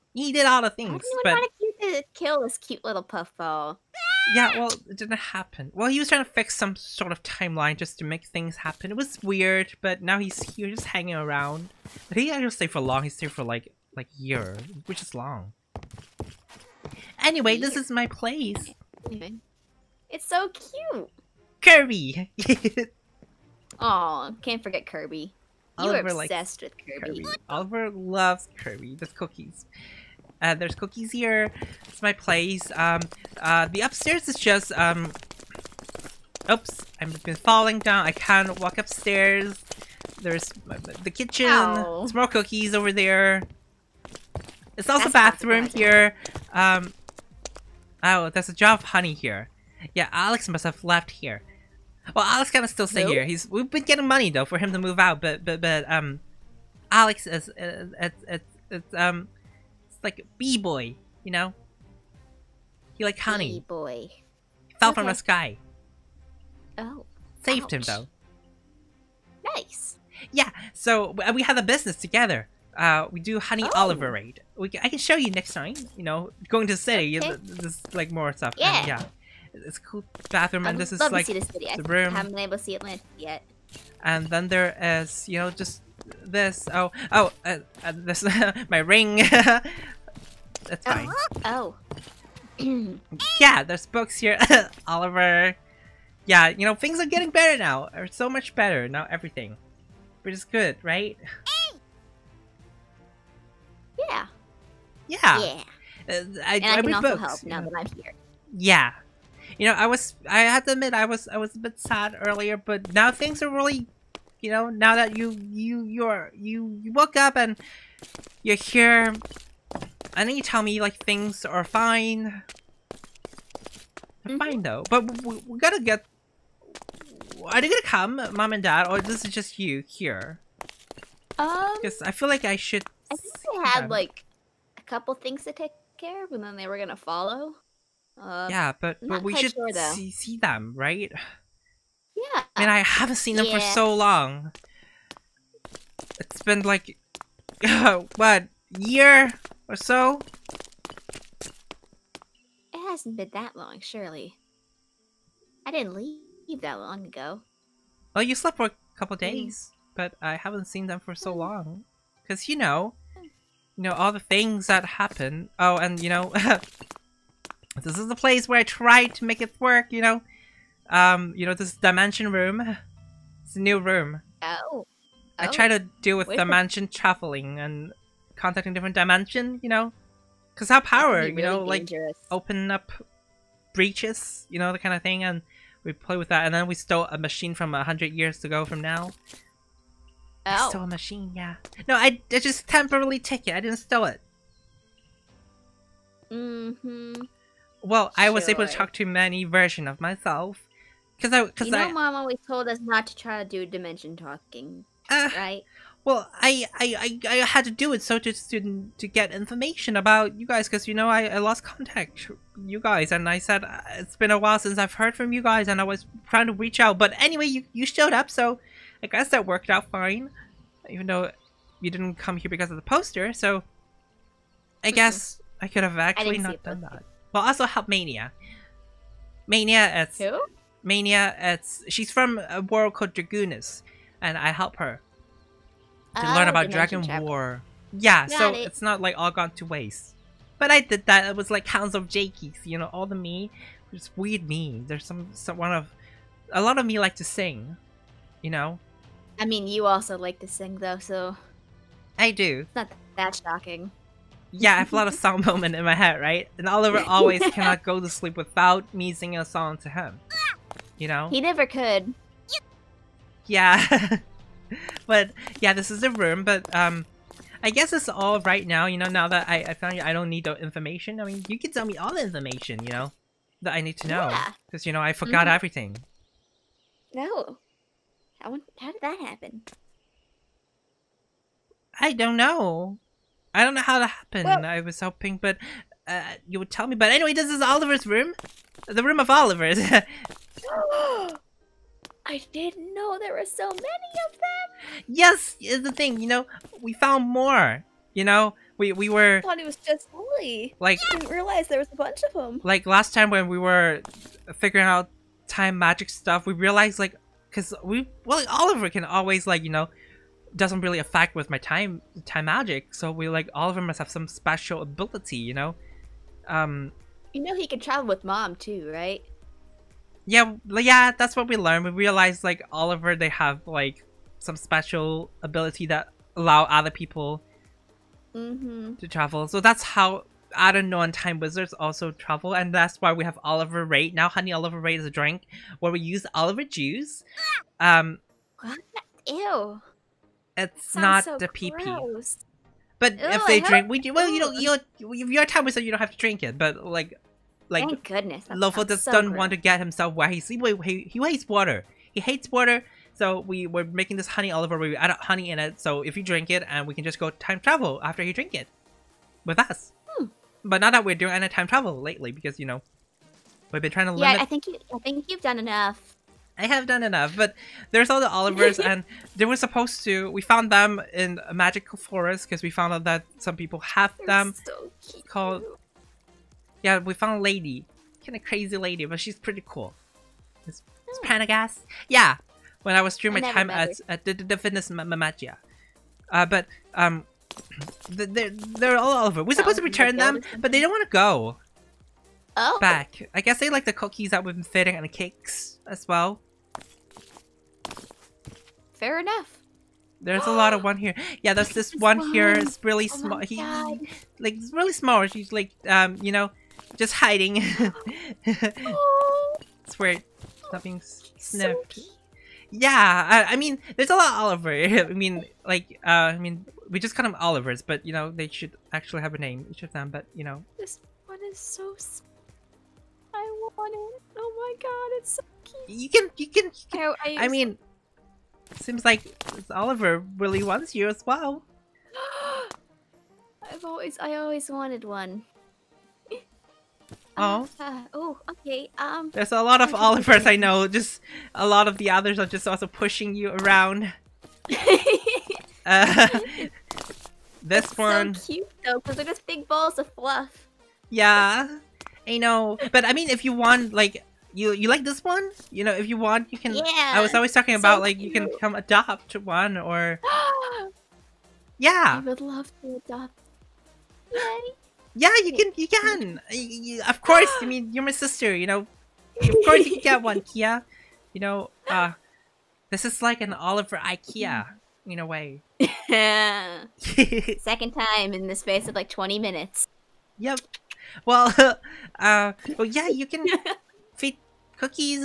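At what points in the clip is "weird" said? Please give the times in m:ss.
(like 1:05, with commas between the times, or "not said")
0:09, 4:04, 6:49.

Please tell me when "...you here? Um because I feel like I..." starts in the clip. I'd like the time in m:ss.
2:09.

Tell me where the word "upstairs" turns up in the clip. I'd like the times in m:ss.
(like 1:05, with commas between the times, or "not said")
0:33, 0:38.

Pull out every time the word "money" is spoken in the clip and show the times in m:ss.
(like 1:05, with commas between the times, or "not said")
0:54.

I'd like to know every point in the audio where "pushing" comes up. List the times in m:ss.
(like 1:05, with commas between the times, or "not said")
7:22.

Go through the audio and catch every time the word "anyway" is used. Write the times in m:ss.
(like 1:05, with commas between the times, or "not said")
0:17, 3:37, 4:47.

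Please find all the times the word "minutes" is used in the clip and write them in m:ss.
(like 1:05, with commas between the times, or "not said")
7:59.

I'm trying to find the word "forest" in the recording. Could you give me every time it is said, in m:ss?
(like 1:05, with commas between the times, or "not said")
6:11.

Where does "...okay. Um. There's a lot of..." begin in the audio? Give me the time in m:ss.
7:18.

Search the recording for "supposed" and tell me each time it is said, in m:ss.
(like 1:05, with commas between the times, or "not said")
6:09, 6:29.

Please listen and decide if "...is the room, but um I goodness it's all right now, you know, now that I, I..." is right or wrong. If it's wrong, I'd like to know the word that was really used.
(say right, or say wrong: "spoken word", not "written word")
wrong: "guess", not "goodness".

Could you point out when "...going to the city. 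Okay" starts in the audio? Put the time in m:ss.
1:16.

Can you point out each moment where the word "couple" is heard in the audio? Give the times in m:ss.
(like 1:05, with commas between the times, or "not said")
2:14, 2:38.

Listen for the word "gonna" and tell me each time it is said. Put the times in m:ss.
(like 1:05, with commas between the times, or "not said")
2:07, 2:16.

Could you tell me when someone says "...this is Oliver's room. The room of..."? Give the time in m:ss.
4:47.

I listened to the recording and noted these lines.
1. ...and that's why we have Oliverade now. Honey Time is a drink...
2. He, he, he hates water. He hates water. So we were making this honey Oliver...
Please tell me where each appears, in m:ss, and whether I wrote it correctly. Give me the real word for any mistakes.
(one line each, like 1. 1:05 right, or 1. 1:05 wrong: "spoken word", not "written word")
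1. 5:32 wrong: "Oliverade", not "Time"
2. 5:50 right.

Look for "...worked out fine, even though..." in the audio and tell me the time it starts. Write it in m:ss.
3:39.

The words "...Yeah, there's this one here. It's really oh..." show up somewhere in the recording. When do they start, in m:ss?
6:41.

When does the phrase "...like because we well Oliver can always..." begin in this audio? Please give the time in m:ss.
5:06.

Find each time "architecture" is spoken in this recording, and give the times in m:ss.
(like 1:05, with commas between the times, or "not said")
not said.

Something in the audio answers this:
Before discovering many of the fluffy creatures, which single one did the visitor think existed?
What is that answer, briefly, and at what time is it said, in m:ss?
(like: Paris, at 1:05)
Lily, at 5:00.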